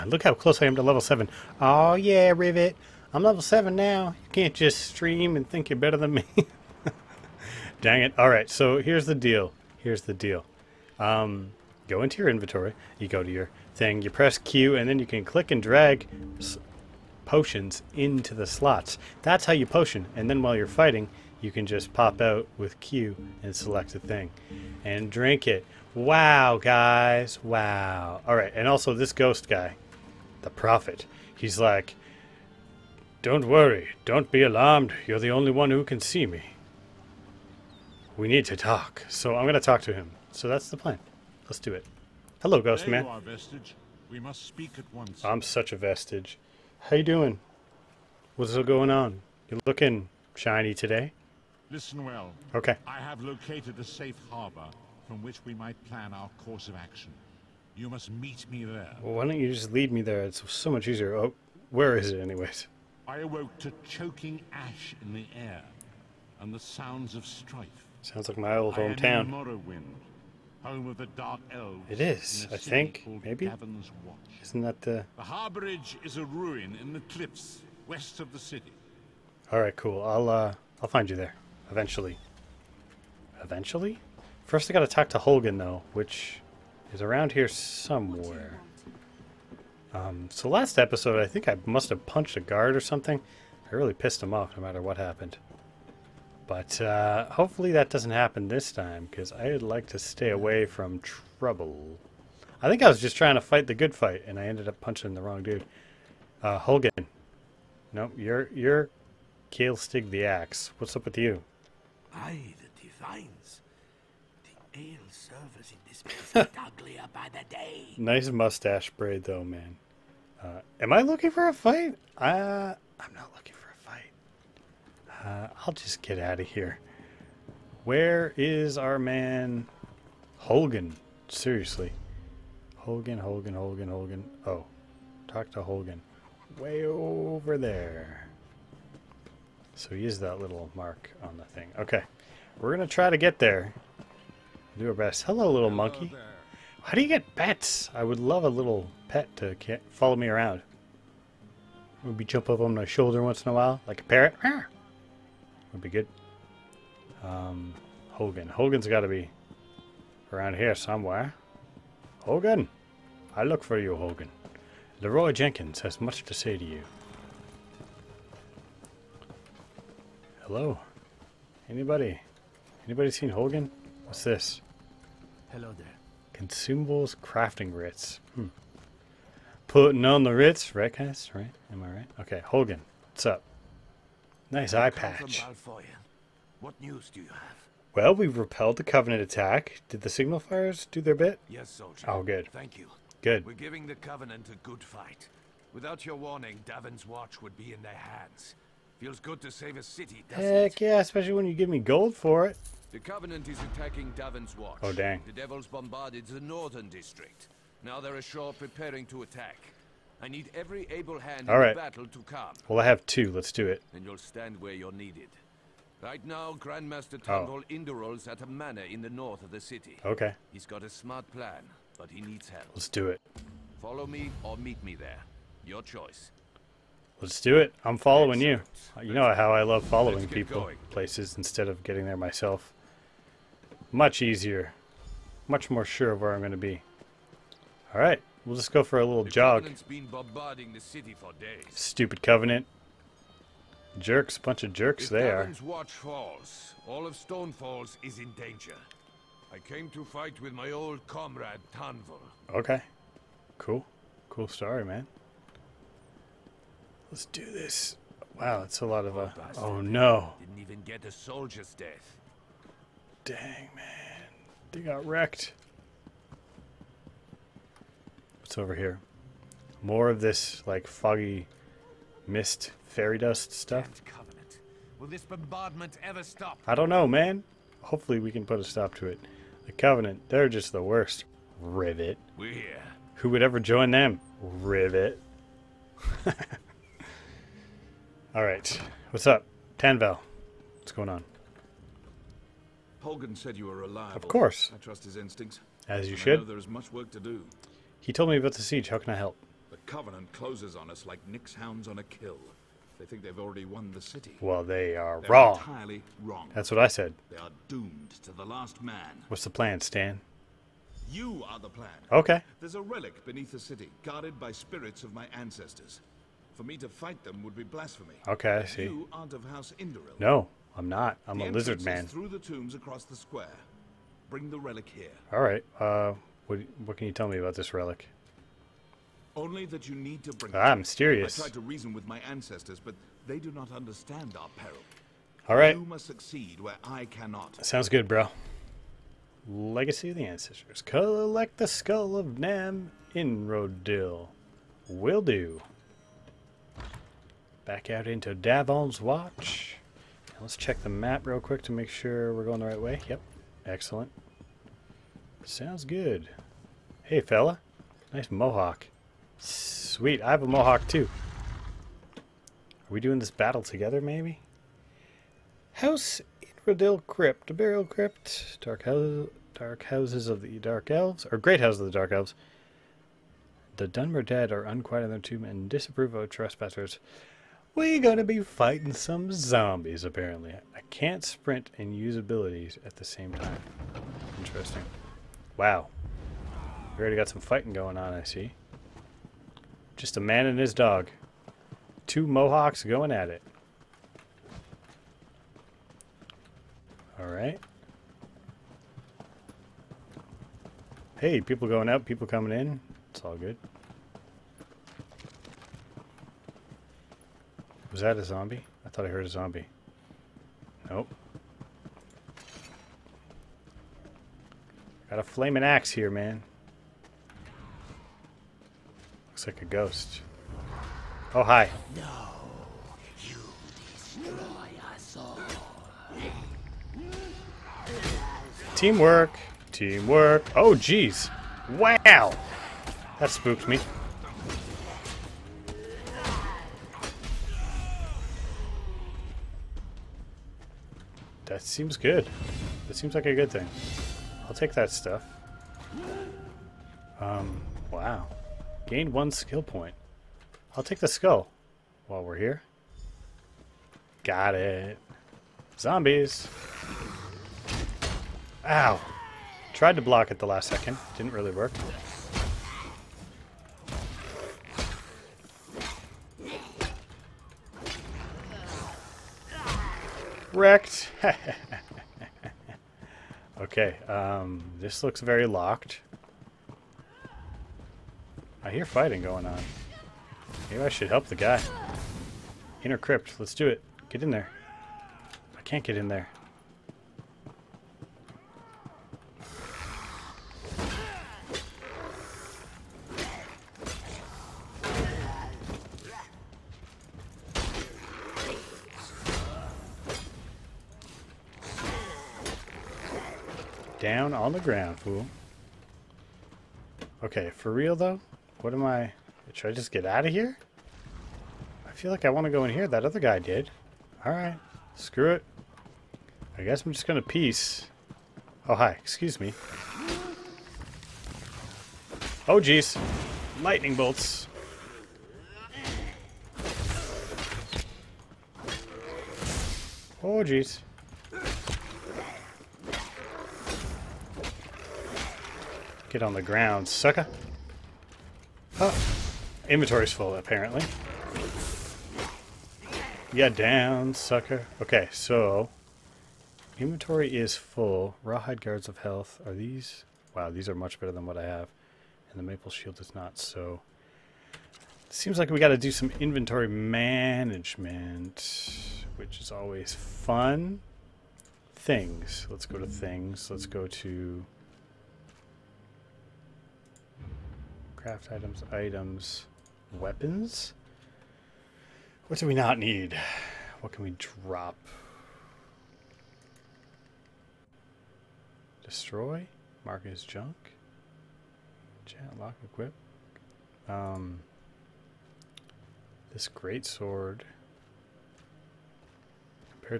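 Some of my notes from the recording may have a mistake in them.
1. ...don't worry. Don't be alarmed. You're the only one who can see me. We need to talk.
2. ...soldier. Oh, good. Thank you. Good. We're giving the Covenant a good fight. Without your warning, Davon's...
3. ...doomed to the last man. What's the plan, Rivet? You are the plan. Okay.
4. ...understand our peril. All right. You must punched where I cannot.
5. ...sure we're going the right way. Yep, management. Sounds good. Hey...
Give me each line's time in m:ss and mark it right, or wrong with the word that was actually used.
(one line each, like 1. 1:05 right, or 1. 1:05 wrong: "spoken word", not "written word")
1. 0:33 right
2. 3:11 right
3. 5:07 wrong: "Stan", not "Rivet"
4. 5:33 wrong: "succeed", not "punched"
5. 5:51 wrong: "excellent", not "management".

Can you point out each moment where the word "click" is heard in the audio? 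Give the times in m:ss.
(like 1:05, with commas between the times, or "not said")
0:15.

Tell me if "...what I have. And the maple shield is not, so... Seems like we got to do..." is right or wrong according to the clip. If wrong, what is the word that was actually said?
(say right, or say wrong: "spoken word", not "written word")
right.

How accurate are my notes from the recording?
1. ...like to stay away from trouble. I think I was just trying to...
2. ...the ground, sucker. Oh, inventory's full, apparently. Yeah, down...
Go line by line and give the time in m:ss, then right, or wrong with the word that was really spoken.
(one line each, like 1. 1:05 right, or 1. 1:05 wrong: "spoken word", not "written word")
1. 1:39 right
2. 8:56 right.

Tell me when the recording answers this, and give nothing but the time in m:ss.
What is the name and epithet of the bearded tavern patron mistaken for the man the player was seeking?
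1:49.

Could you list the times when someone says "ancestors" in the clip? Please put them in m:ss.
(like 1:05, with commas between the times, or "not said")
5:15, 5:32, 5:40.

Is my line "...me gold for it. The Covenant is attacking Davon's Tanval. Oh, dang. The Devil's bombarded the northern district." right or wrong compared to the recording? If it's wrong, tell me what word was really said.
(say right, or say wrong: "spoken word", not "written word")
wrong: "Watch", not "Tanval".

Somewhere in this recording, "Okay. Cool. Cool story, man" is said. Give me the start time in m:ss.
4:12.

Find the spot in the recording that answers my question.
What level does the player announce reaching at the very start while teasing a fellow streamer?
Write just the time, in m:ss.
0:03.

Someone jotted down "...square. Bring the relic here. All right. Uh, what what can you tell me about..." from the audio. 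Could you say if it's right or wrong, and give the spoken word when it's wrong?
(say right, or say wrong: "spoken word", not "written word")
right.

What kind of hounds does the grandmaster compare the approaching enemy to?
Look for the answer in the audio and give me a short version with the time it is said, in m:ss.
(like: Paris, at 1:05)
Nix-hounds, at 5:01.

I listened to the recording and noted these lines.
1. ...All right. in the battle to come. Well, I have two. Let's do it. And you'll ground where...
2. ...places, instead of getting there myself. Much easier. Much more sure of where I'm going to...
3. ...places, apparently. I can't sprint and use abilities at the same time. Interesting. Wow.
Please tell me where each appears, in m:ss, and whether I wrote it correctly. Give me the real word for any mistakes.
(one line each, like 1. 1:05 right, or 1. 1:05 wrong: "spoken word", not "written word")
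1. 3:31 wrong: "stand", not "ground"
2. 3:50 right
3. 6:19 wrong: "zombies", not "places".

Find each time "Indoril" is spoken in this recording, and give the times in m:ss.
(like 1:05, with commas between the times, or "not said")
3:37, 5:19, 6:06.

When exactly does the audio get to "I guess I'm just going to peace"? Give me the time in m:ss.
8:36.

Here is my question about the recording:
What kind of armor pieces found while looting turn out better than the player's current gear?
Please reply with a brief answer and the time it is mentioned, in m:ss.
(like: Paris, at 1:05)
Rawhide guards, at 9:08.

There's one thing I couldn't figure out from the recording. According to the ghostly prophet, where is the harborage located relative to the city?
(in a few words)
In the cliffs west of the city.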